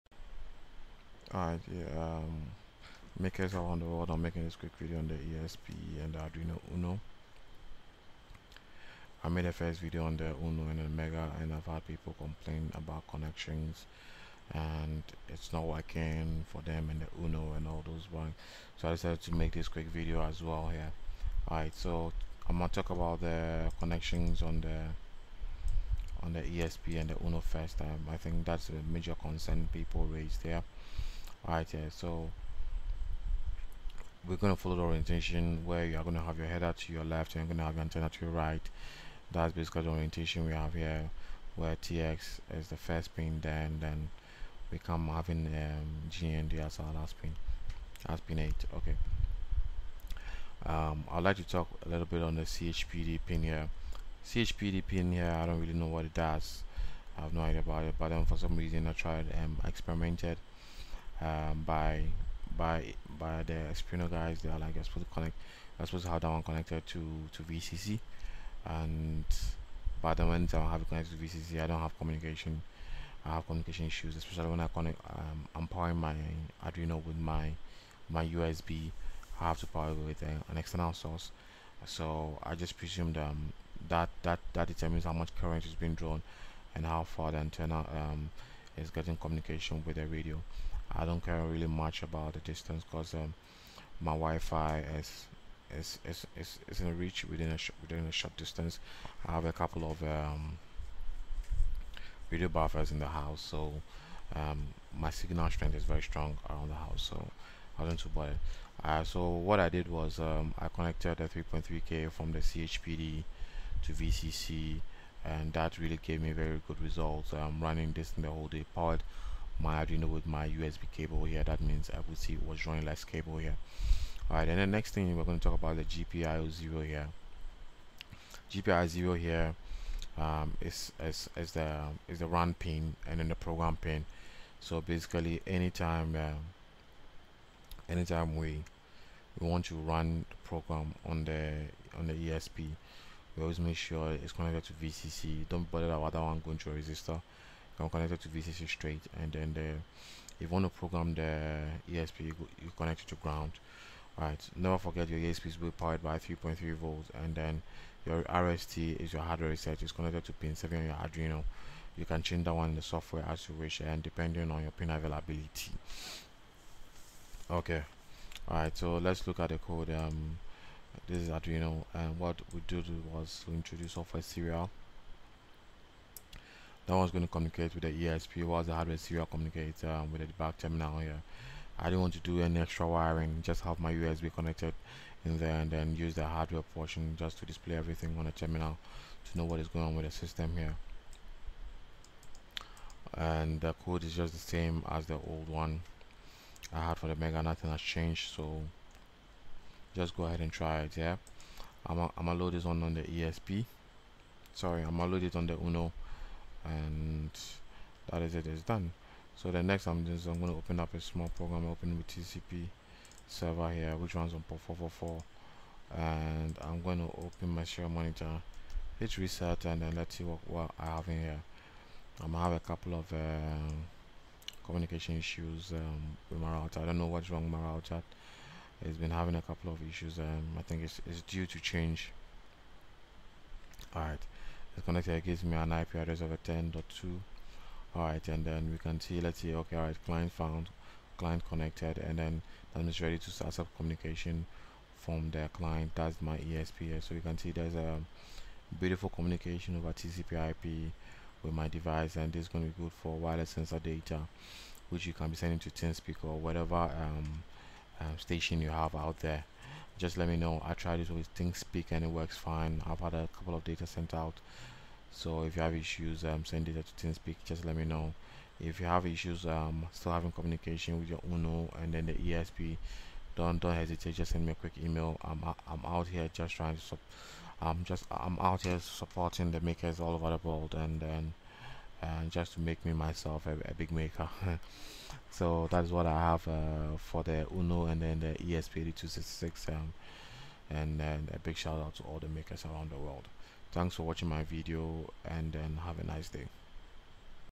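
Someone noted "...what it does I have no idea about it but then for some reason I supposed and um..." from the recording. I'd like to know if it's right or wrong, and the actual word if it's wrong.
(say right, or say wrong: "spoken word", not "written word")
wrong: "tried", not "supposed".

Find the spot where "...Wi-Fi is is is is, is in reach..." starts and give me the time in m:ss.
1:34.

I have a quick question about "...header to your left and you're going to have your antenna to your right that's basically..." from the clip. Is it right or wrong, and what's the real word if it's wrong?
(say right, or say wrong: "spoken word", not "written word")
right.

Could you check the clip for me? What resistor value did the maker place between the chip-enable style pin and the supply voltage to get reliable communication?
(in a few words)
3.3k.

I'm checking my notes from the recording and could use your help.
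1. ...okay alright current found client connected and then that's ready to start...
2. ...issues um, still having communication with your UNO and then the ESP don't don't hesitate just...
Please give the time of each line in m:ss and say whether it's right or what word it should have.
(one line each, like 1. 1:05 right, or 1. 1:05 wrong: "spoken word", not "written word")
1. 3:59 wrong: "client", not "current"
2. 4:29 right.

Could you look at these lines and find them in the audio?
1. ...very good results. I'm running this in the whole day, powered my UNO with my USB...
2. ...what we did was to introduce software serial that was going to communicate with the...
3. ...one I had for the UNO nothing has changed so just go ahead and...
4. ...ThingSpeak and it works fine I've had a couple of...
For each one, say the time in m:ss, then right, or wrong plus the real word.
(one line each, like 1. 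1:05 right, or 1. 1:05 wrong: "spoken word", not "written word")
1. 1:56 wrong: "Arduino", not "UNO"
2. 2:52 right
3. 3:15 wrong: "Mega", not "UNO"
4. 4:21 right.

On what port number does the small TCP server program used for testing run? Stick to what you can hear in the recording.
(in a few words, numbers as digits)
444.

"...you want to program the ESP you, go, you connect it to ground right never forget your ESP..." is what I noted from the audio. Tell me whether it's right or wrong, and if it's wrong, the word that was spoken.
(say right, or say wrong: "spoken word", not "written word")
right.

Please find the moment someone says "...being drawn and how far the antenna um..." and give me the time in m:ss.
1:25.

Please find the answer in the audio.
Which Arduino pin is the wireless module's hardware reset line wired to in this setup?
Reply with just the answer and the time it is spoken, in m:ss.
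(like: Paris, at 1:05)
7, at 2:40.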